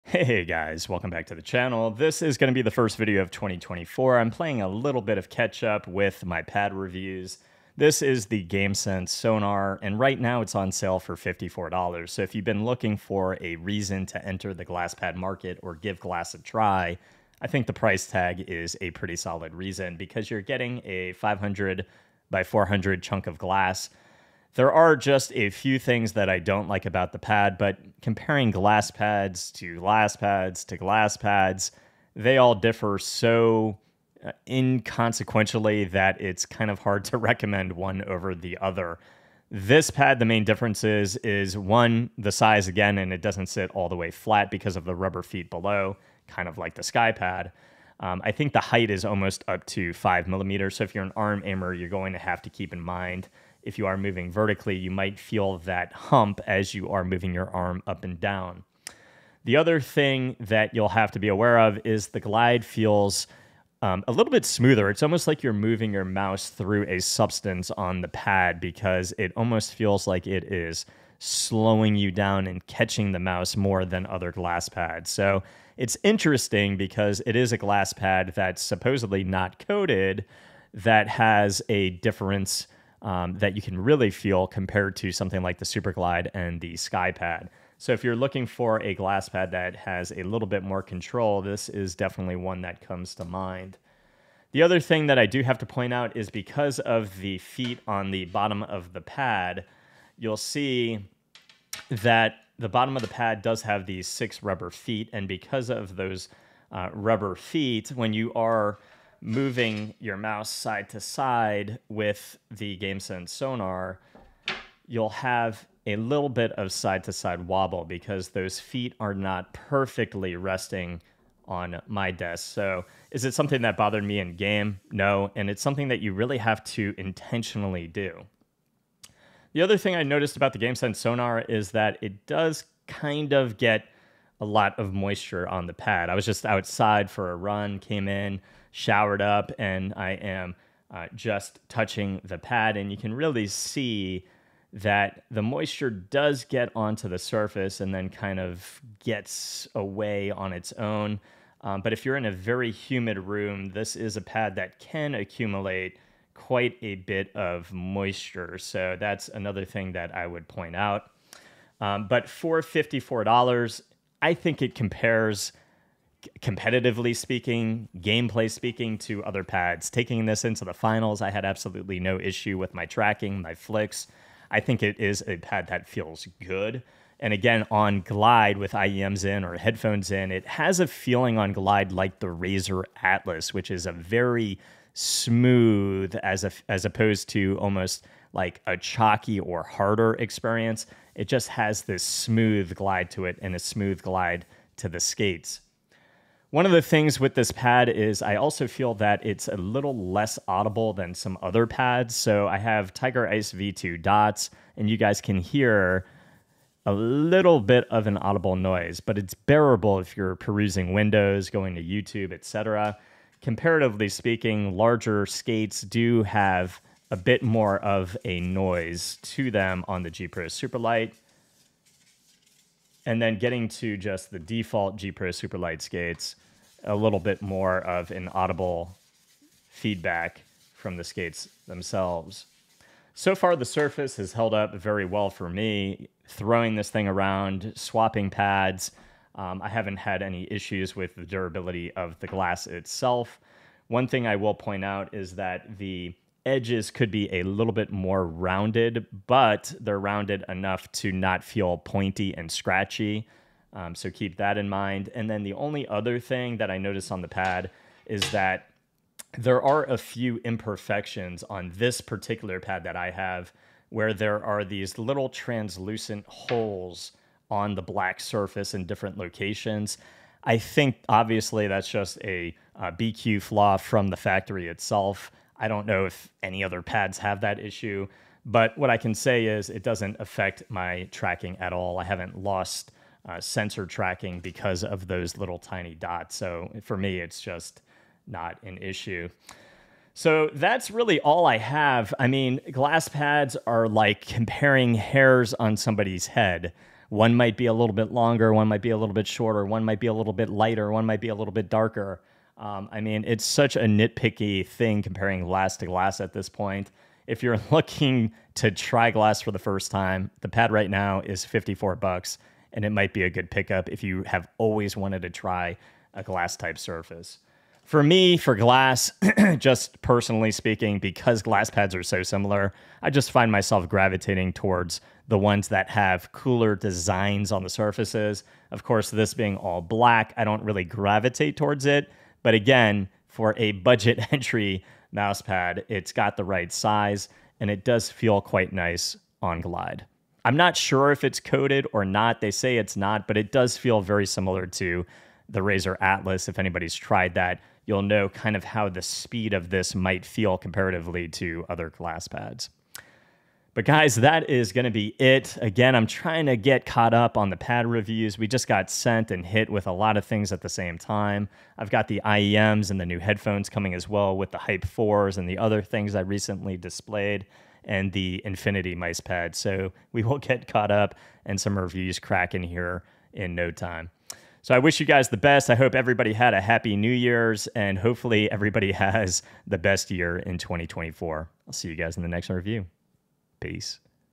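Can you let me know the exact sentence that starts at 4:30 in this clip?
I think obviously that's just a, a uh, BQ flaw from the factory itself.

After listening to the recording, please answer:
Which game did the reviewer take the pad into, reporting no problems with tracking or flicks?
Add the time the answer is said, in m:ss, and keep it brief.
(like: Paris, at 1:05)
The Finals, at 2:50.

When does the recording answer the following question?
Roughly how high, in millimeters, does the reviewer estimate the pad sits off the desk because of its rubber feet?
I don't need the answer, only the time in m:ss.
0:49.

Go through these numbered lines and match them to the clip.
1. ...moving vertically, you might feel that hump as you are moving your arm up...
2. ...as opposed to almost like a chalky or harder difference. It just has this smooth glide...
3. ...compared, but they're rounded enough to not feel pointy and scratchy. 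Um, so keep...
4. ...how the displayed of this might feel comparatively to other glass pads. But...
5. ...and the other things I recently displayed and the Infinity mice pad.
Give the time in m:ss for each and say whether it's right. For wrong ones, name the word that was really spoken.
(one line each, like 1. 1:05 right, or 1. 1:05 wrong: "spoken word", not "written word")
1. 0:53 right
2. 3:06 wrong: "experience", not "difference"
3. 4:08 wrong: "rounded", not "compared"
4. 5:48 wrong: "speed", not "displayed"
5. 6:05 right.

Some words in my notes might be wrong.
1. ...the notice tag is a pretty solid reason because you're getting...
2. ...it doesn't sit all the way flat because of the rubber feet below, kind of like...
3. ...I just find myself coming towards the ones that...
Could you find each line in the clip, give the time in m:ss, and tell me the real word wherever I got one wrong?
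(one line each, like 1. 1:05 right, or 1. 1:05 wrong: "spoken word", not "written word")
1. 0:17 wrong: "price", not "notice"
2. 0:43 right
3. 5:23 wrong: "gravitating", not "coming".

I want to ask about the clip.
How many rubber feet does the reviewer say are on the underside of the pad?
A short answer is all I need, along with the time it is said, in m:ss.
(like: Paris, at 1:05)
6, at 1:44.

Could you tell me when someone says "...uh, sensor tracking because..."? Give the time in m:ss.
4:43.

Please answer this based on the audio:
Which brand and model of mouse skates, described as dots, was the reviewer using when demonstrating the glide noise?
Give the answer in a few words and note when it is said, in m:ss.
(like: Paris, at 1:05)
Tiger Ice V2, at 3:22.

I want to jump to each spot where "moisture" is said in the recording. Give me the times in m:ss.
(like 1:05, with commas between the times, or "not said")
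2:14, 2:25, 2:37.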